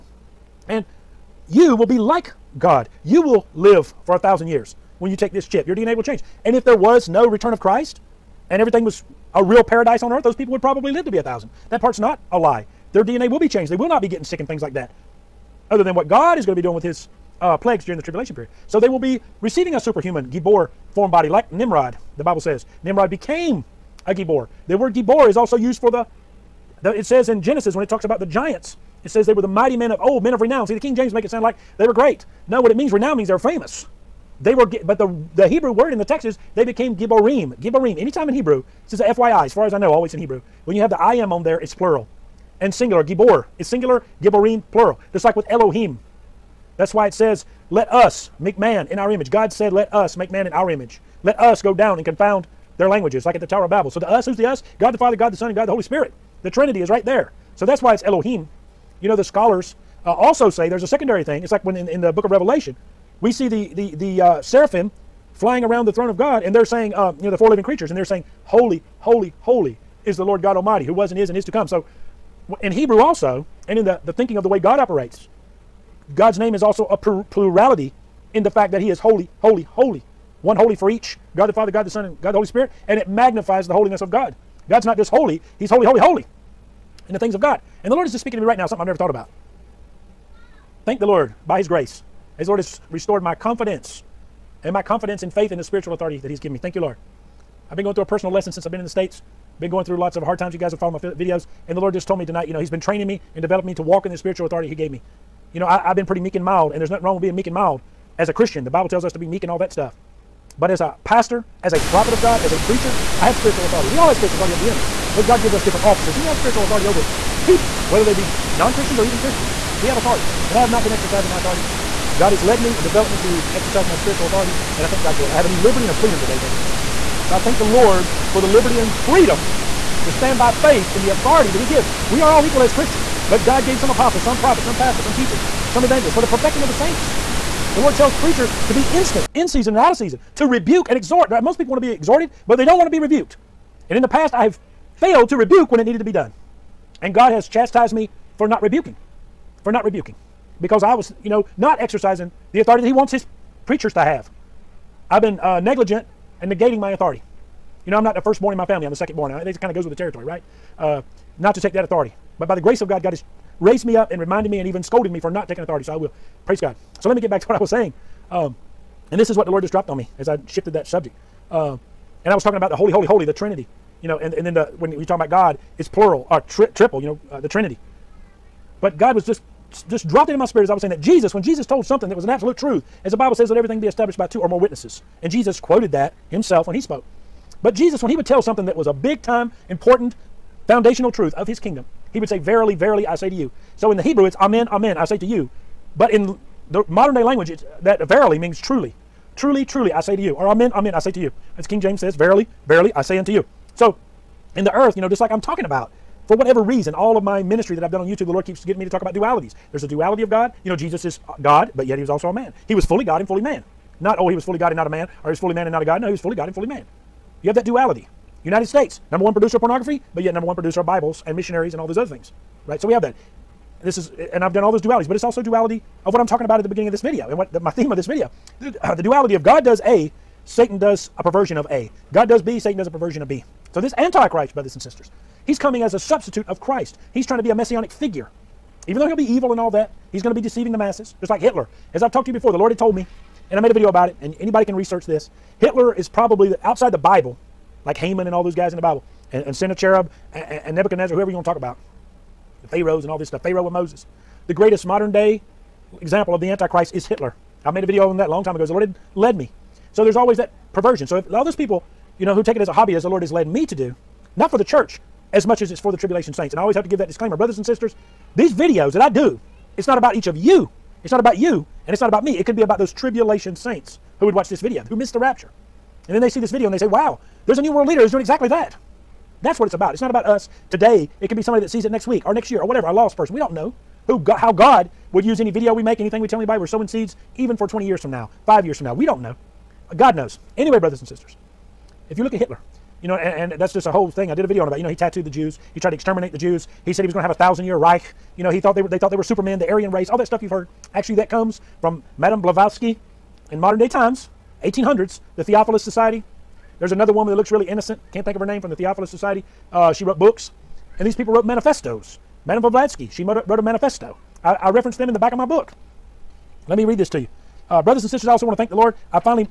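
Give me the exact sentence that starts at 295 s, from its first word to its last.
He tried to exterminate the Jews.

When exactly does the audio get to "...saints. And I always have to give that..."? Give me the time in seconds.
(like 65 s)
266 s.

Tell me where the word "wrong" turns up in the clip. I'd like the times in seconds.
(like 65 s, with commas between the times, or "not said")
107 s.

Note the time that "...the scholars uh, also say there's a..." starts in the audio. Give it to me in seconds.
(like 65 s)
59 s.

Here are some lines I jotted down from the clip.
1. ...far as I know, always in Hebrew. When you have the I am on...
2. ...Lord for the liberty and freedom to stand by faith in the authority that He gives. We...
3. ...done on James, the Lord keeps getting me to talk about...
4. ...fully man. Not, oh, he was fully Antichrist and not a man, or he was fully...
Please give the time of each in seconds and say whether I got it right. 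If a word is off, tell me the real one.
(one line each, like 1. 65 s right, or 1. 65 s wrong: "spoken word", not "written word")
1. 39 s right
2. 127 s right
3. 207 s wrong: "YouTube", not "James"
4. 213 s wrong: "God", not "Antichrist".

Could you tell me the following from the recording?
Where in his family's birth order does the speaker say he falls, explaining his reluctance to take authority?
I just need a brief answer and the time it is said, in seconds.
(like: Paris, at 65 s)
Secondborn, at 158 s.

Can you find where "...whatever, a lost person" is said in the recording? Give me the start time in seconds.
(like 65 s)
282 s.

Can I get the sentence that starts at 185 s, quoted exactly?
And Jesus quoted that himself when he spoke.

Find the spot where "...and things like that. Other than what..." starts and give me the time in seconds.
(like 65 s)
14 s.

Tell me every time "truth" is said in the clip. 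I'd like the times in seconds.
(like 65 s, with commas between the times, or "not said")
182 s, 191 s.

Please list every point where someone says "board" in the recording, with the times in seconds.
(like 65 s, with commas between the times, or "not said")
not said.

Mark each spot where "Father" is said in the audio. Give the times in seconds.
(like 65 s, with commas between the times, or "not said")
54 s, 81 s.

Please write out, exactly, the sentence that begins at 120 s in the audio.
And I have not been exercising my authority.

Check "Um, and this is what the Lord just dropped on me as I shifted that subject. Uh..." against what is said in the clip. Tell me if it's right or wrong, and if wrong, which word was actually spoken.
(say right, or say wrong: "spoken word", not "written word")
right.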